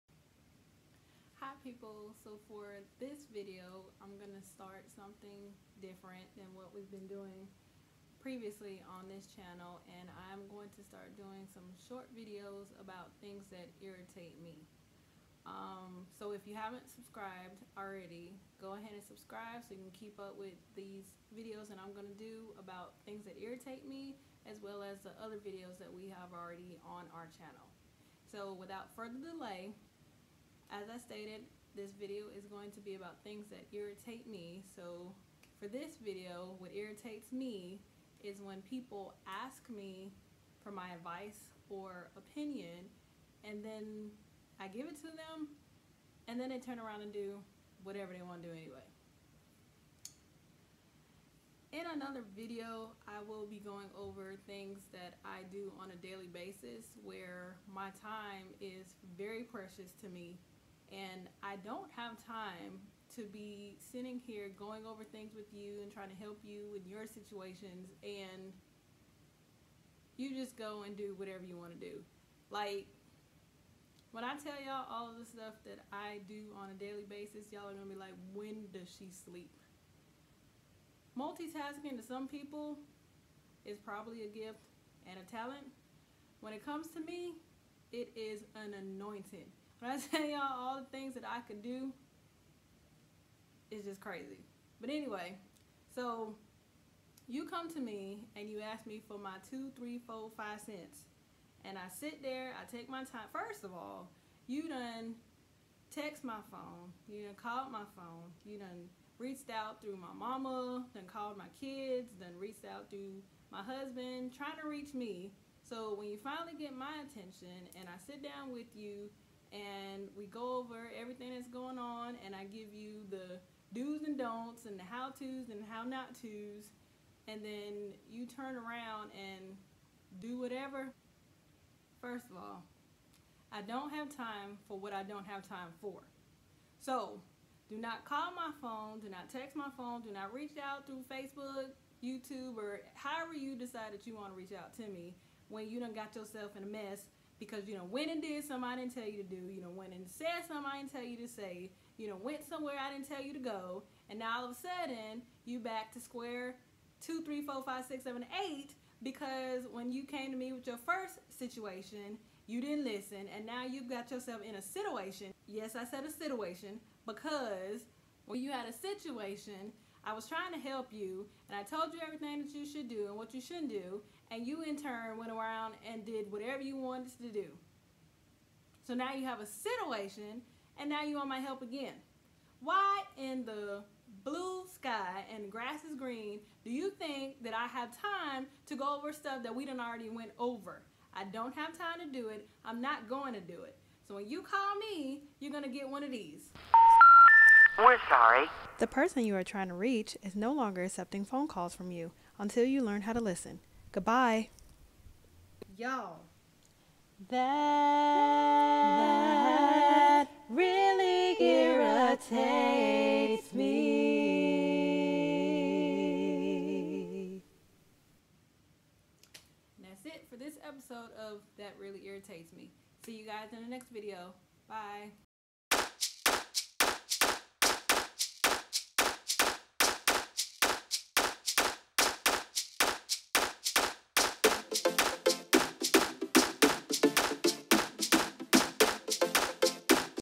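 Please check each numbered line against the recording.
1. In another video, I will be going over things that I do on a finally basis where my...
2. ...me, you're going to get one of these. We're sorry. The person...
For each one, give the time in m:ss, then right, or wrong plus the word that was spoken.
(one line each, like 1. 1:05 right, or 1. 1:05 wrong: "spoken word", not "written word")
1. 0:51 wrong: "daily", not "finally"
2. 3:14 right.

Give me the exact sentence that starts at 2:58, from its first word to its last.
So now you have a situation and now you want my help again.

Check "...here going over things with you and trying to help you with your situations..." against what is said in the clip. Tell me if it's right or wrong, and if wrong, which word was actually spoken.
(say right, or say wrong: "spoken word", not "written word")
right.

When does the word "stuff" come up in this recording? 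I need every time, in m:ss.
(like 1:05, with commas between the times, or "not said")
1:15, 3:09.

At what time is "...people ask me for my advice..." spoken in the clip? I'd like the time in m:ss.
0:38.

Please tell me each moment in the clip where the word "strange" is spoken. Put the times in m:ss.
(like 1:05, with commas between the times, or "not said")
not said.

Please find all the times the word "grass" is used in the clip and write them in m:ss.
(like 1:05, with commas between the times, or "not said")
3:05.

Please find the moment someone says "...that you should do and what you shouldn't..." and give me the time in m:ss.
2:52.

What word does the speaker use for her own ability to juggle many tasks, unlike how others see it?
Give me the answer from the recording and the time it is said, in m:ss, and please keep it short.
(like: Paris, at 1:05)
anointing, at 1:28.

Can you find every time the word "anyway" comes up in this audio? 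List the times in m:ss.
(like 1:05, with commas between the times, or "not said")
0:48, 1:34.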